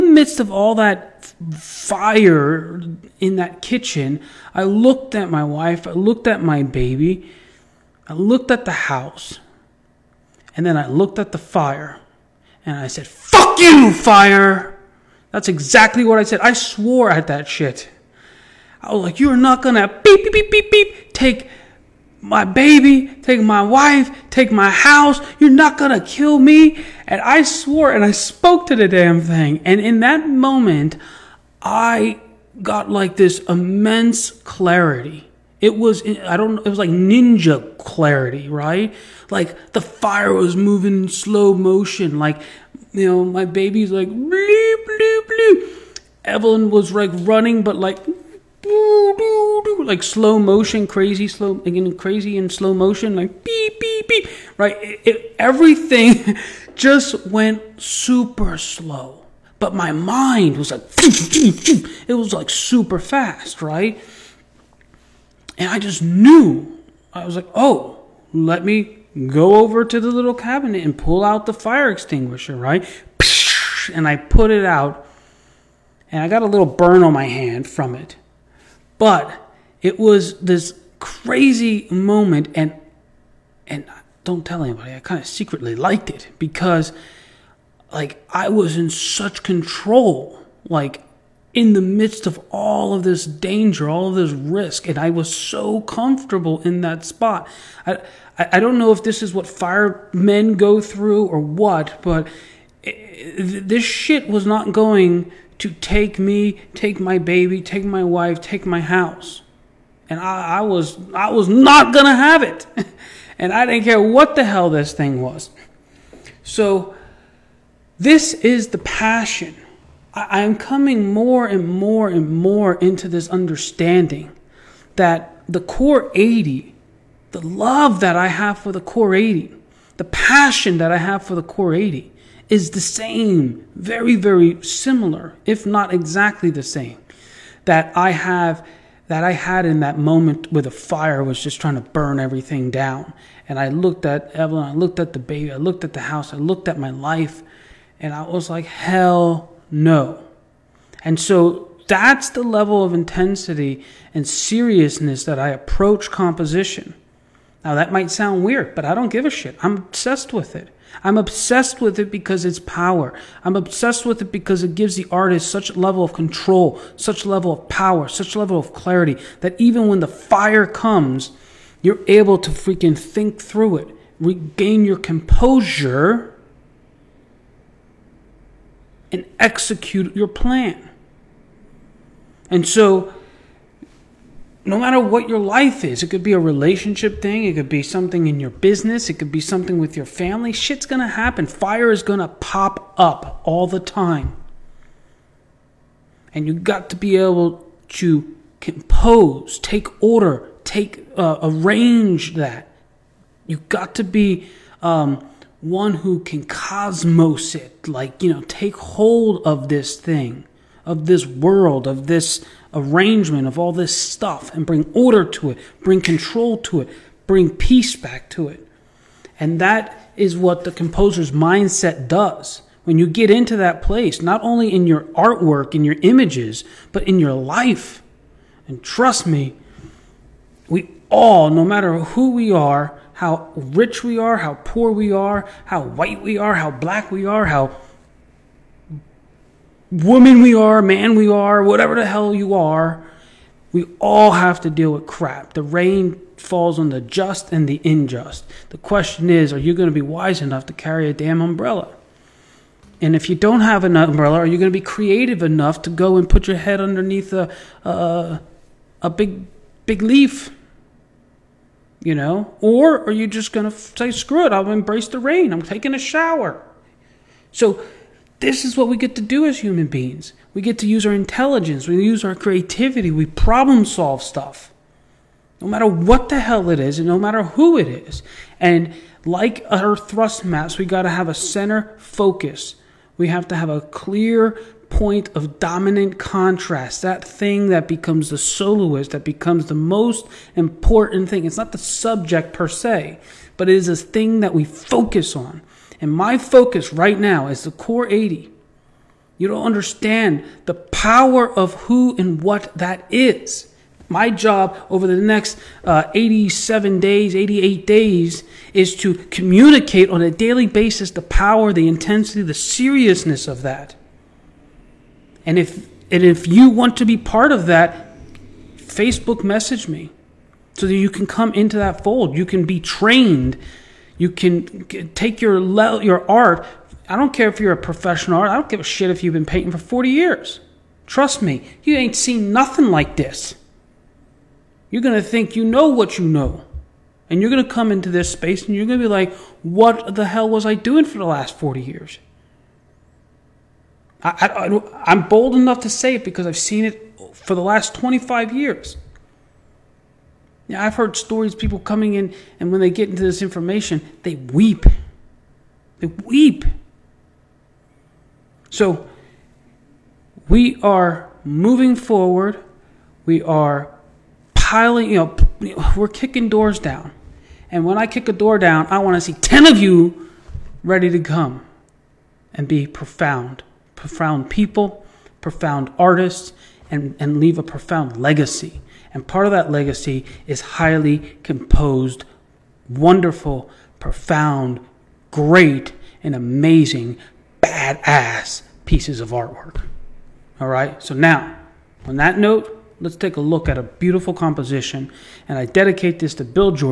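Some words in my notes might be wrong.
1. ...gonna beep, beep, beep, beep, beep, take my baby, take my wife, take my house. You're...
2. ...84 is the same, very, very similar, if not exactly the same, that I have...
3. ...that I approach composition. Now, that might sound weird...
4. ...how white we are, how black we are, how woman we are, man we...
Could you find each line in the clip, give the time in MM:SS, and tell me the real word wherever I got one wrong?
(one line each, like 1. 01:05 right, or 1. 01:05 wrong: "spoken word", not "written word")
1. 00:19 right
2. 02:11 wrong: "80", not "84"
3. 02:35 right
4. 03:55 right.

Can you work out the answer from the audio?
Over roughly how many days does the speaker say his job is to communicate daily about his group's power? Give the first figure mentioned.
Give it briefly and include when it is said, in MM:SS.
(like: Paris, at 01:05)
87, at 05:06.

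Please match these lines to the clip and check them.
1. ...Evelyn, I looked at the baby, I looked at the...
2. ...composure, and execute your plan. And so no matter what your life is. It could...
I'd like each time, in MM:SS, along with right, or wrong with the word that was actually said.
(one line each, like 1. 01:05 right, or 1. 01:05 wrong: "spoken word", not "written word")
1. 02:24 right
2. 02:54 right.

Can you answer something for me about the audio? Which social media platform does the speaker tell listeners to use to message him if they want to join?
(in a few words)
Facebook.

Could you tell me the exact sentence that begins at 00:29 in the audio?
And in that moment, I got like this immense clarity.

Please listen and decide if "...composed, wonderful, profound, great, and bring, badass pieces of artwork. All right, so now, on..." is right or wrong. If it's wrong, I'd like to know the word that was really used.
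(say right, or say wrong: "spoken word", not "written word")
wrong: "amazing", not "bring".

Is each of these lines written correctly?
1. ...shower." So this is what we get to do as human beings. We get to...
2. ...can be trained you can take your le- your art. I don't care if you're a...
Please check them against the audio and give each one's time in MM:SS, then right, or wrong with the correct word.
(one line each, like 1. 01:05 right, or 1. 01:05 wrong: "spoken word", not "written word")
1. 04:25 right
2. 05:22 right.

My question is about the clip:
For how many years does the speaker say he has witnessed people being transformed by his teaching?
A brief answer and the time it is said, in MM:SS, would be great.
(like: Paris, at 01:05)
25, at 05:47.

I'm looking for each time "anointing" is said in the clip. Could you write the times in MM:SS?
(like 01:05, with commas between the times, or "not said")
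not said.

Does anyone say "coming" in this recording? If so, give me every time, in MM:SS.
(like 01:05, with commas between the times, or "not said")
02:00, 05:51.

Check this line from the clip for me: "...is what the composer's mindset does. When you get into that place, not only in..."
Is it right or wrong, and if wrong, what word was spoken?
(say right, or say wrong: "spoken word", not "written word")
right.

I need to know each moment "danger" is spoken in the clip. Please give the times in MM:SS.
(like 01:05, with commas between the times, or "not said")
01:33.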